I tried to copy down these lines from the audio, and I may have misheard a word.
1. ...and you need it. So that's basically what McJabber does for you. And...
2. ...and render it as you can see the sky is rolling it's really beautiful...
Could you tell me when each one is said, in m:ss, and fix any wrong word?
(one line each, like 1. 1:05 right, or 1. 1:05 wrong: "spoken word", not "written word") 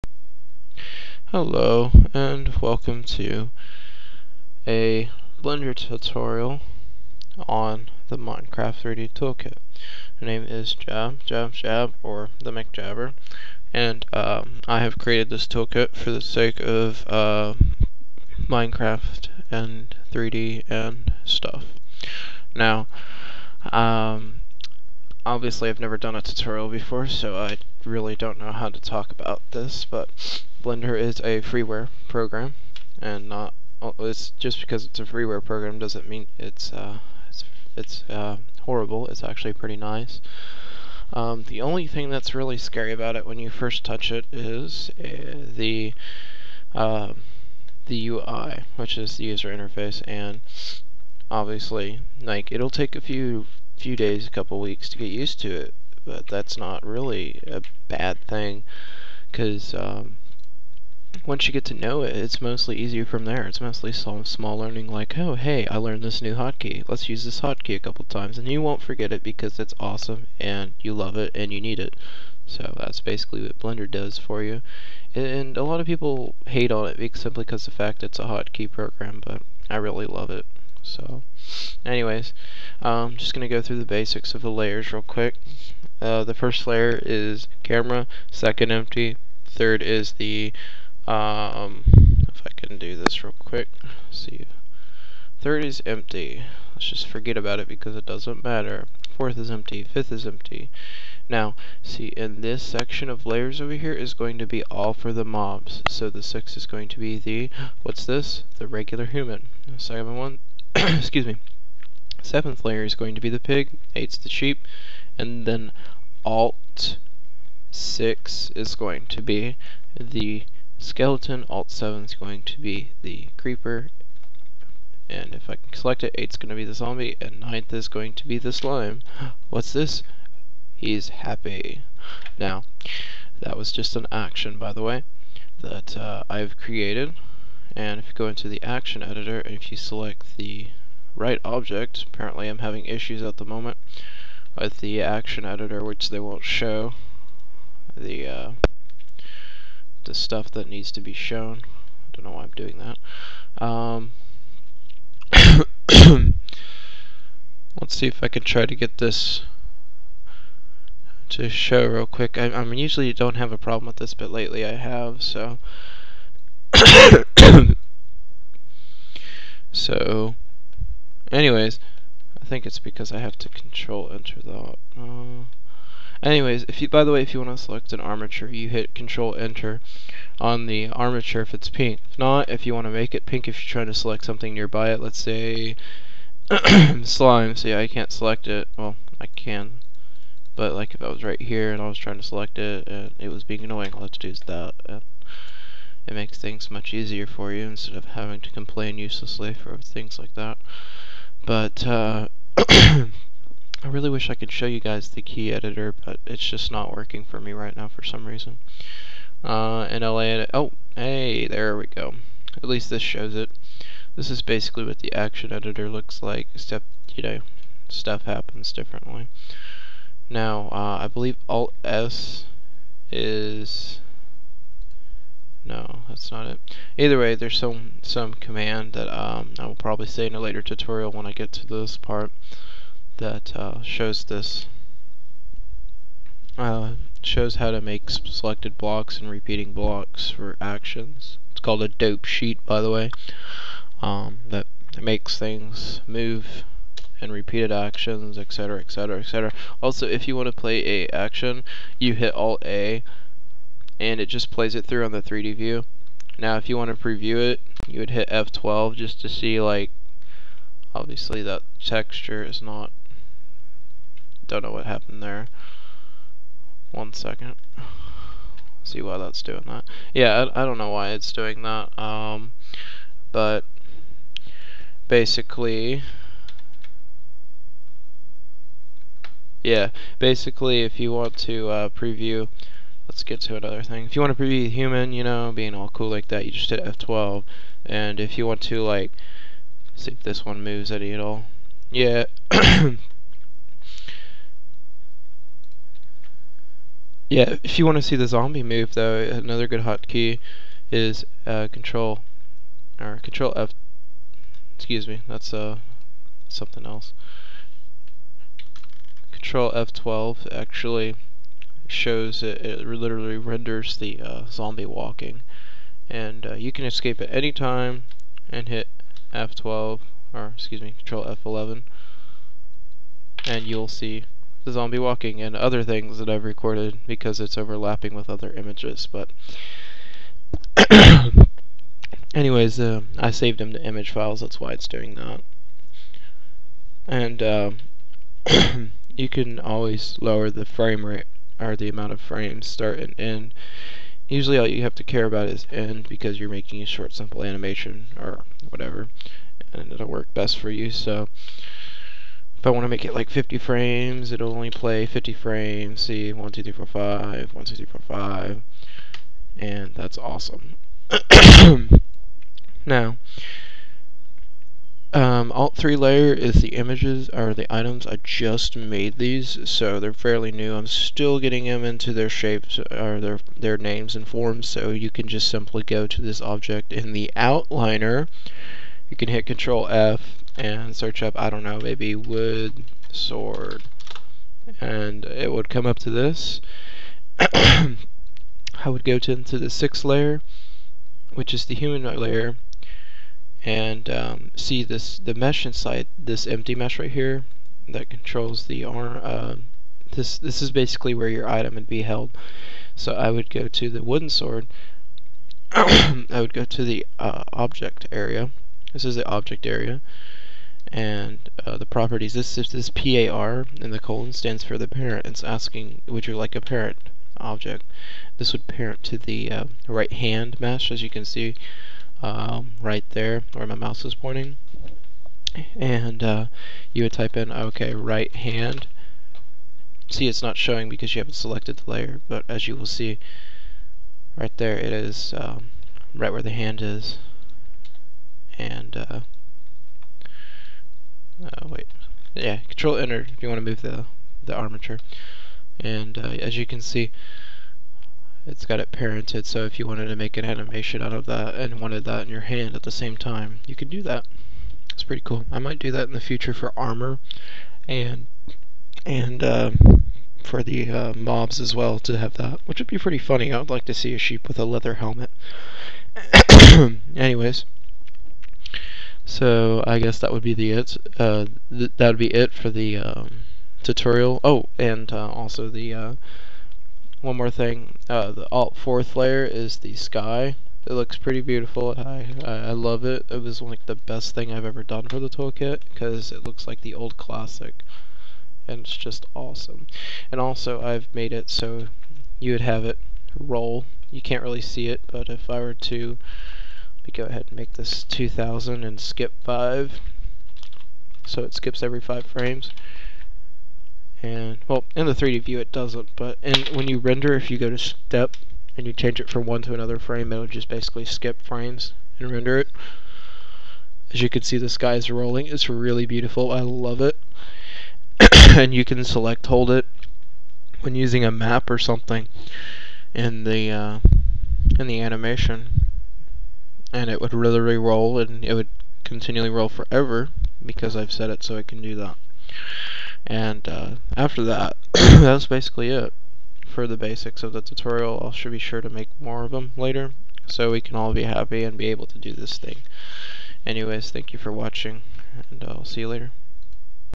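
1. 1:11 wrong: "Blender", not "McJabber"
2. 8:32 right.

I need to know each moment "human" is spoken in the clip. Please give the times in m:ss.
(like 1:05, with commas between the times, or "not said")
1:49, 4:44, 6:31.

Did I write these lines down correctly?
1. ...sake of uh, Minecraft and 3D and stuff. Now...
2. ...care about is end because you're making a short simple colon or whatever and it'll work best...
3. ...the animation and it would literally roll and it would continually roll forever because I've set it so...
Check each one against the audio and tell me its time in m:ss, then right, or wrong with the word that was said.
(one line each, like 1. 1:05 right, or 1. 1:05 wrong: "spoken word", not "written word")
1. 0:16 right
2. 5:45 wrong: "animation", not "colon"
3. 8:44 right.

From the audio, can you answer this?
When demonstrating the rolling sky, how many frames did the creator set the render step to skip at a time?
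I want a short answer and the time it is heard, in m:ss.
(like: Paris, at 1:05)
5, at 8:18.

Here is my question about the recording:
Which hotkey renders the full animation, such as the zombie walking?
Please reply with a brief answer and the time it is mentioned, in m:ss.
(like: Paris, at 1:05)
Control F12, at 5:09.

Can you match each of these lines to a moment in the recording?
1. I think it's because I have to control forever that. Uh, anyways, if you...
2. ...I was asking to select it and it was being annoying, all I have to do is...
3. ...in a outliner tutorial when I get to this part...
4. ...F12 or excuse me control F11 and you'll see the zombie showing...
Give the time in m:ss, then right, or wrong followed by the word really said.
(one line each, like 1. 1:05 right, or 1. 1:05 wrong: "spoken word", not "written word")
1. 2:52 wrong: "enter", not "forever"
2. 3:11 wrong: "trying", not "asking"
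3. 3:50 wrong: "later", not "outliner"
4. 5:19 wrong: "walking", not "showing".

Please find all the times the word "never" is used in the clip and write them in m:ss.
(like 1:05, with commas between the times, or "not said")
0:25.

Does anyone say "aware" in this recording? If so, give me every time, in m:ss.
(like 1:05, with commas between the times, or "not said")
not said.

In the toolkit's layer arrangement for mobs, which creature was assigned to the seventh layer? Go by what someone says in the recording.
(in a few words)
pig.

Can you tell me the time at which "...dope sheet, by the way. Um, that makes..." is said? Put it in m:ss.
4:01.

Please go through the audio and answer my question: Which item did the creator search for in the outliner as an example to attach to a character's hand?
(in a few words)
wood sword.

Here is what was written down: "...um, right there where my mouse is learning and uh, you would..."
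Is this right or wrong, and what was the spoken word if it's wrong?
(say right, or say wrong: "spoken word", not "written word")
wrong: "pointing", not "learning".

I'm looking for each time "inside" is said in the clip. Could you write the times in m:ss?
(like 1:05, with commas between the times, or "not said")
6:35.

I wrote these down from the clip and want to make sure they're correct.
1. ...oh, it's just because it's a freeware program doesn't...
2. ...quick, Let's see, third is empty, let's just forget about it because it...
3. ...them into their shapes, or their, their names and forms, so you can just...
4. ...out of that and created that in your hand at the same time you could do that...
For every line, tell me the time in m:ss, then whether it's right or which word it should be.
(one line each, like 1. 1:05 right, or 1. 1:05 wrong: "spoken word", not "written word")
1. 0:33 right
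2. 1:33 right
3. 6:11 right
4. 7:31 wrong: "wanted", not "created".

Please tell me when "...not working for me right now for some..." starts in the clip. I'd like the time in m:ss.
3:26.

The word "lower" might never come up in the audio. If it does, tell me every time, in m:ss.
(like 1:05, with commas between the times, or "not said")
5:40.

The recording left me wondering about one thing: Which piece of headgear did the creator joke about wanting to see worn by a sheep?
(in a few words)
leather helmet.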